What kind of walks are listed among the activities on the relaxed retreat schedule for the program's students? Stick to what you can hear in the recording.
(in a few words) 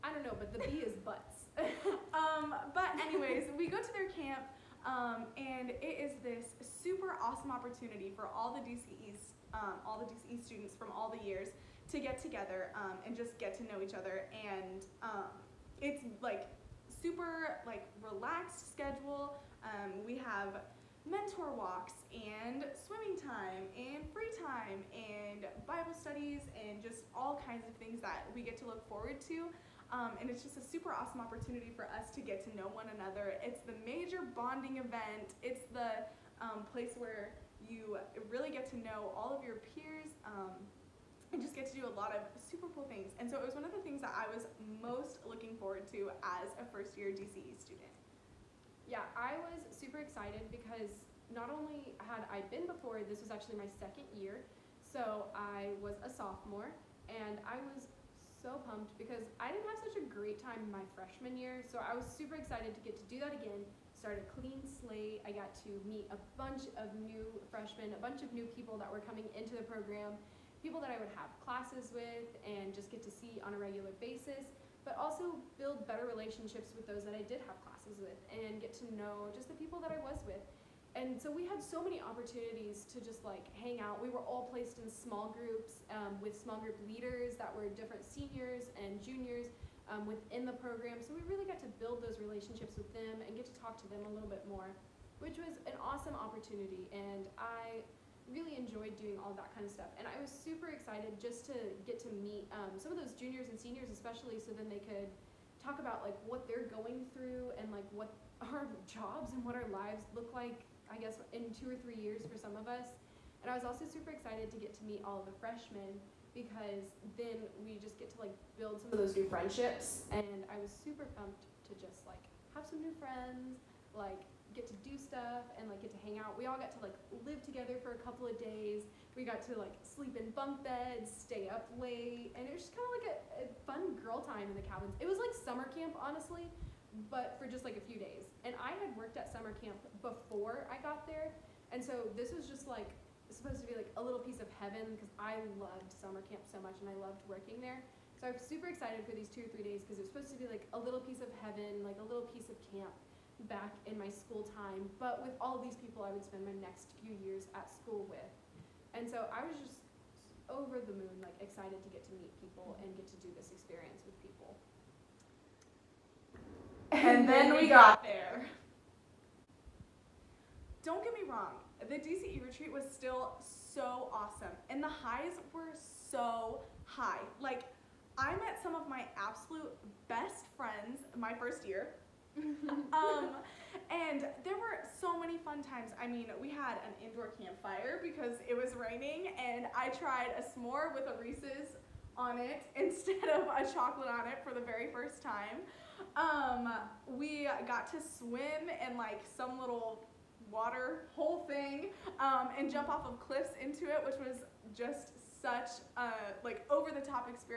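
Mentor walks.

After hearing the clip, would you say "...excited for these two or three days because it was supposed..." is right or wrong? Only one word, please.
right.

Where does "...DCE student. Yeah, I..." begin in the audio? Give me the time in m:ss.
0:47.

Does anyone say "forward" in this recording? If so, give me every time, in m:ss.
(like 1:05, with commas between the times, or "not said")
0:28, 0:45.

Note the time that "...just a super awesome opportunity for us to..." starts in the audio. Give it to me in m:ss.
0:30.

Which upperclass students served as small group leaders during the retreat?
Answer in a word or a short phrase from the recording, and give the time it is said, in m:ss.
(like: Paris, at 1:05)
Seniors and juniors, at 1:28.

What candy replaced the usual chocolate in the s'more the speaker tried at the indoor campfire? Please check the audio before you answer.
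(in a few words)
Reese's.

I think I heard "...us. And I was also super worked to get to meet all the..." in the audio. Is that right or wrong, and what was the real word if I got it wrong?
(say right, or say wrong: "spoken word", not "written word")
wrong: "excited", not "worked".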